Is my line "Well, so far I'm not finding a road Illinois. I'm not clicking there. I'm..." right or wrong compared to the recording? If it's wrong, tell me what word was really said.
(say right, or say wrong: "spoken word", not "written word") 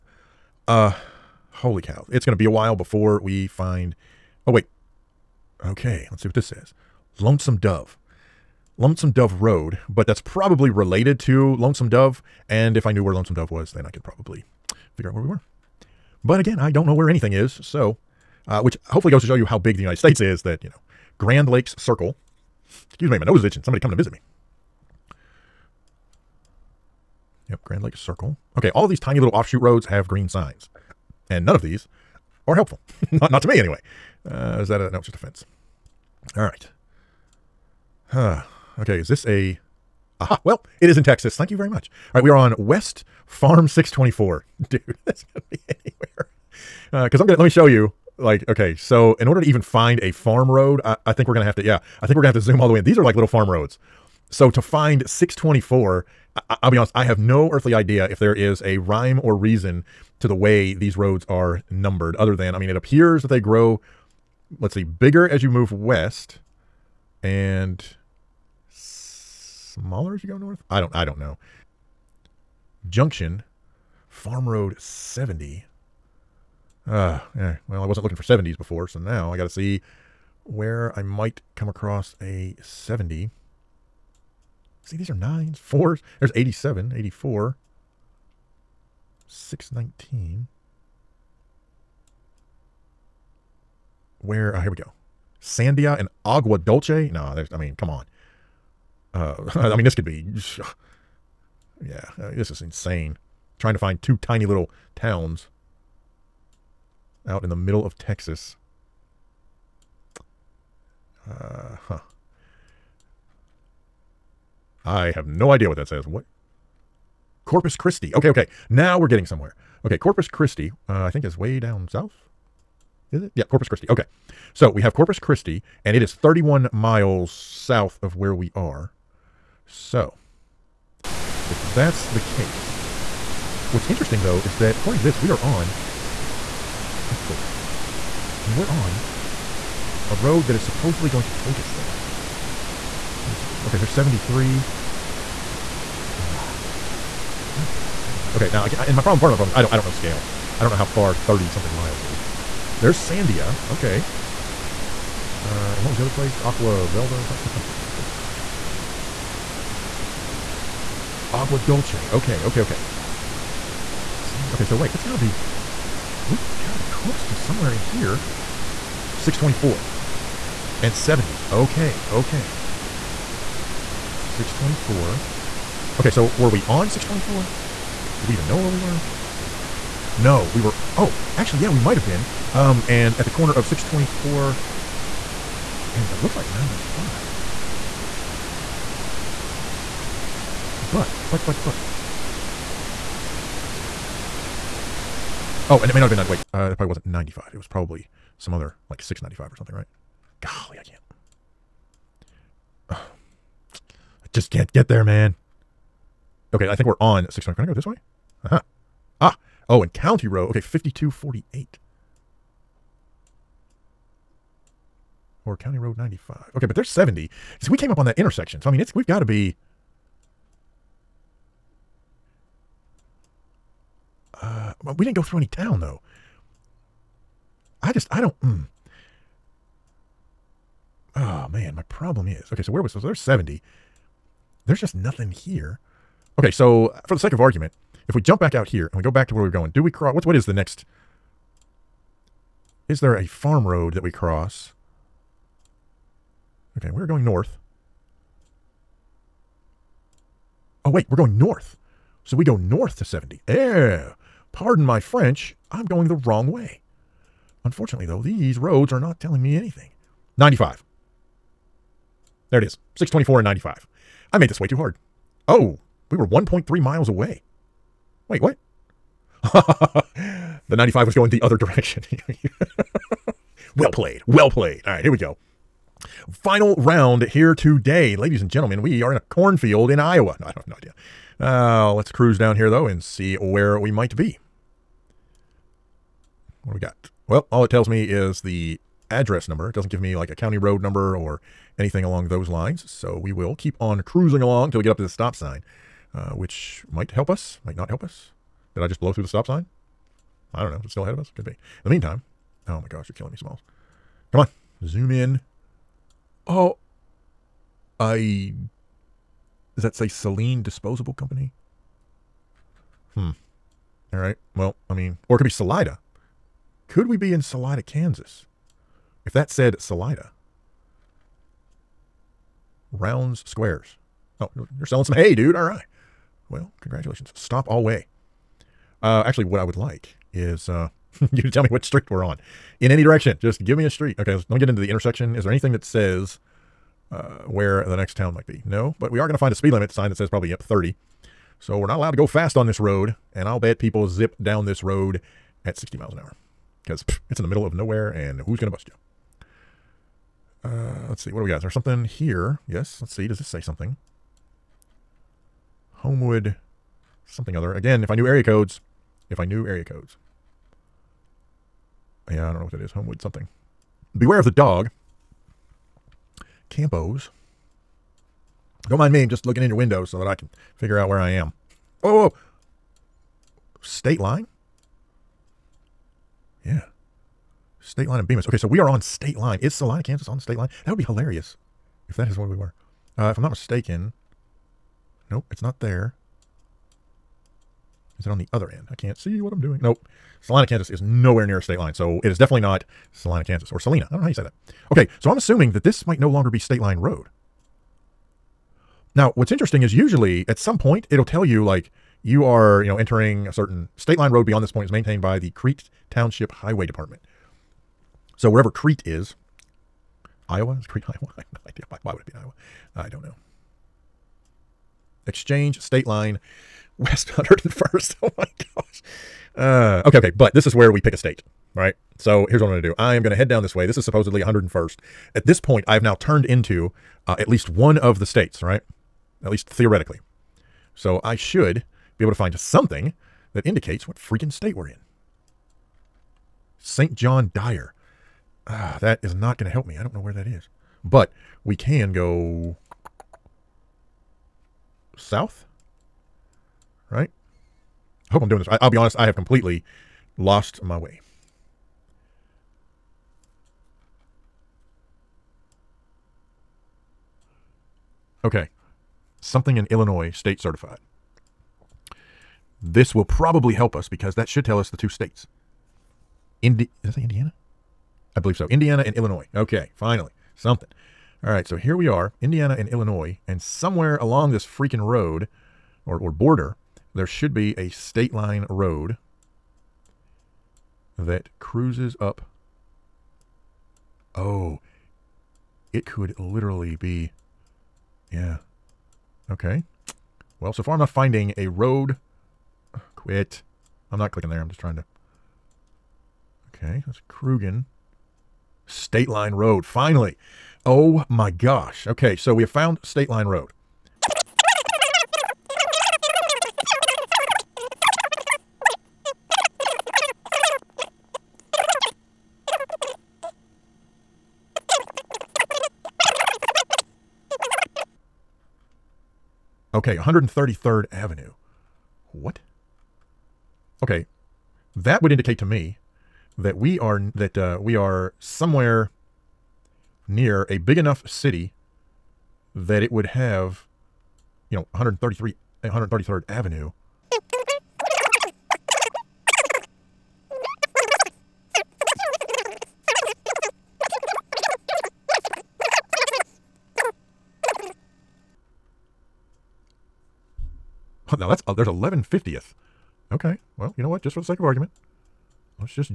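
wrong: "Quit", not "Illinois".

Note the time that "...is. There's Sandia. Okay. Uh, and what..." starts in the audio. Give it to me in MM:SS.
02:32.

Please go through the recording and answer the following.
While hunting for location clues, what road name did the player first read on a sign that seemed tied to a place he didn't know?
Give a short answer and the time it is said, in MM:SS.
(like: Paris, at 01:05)
Lonesome Dove Road, at 00:08.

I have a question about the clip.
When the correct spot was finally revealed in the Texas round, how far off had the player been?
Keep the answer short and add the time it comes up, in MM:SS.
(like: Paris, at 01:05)
1.3 miles, at 04:26.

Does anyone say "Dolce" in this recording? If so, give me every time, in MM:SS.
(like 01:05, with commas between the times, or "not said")
01:36, 02:41.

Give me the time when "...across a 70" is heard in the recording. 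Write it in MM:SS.
01:21.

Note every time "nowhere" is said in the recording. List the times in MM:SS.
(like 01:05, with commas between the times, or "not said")
05:47, 06:30.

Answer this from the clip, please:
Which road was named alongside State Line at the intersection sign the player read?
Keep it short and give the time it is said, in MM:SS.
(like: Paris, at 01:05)
Bemis, at 06:18.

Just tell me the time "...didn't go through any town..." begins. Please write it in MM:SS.
03:45.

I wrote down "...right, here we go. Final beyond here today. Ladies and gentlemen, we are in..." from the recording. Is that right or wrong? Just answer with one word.
wrong.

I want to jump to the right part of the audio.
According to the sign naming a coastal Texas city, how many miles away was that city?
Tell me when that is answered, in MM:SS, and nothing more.
02:06.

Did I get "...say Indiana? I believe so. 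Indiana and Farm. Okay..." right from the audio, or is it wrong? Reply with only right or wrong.
wrong.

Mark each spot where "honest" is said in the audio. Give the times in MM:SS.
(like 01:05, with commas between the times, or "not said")
00:56, 07:28.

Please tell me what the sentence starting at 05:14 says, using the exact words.
Well, I mean, or it could be Salida.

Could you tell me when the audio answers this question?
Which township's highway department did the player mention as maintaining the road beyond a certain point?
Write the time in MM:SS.
06:45.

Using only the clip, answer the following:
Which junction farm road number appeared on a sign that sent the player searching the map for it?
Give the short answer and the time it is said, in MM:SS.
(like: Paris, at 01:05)
70, at 01:12.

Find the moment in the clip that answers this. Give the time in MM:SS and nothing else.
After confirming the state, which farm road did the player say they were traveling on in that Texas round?
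00:42.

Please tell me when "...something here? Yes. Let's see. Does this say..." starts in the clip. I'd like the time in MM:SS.
05:51.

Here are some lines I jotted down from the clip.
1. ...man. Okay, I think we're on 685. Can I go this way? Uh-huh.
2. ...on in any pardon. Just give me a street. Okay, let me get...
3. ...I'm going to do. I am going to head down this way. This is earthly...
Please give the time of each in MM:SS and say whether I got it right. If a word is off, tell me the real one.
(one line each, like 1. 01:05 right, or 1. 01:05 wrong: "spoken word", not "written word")
1. 03:25 wrong: "625", not "685"
2. 05:32 wrong: "direction", not "pardon"
3. 07:02 wrong: "supposedly", not "earthly".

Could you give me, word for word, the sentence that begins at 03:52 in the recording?
So where was so there's seventy.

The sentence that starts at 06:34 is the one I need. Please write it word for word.
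Okay, so I'm assuming that this might no longer be State Line Road.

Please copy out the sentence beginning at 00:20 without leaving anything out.
That you know, Grand Lakes Circle.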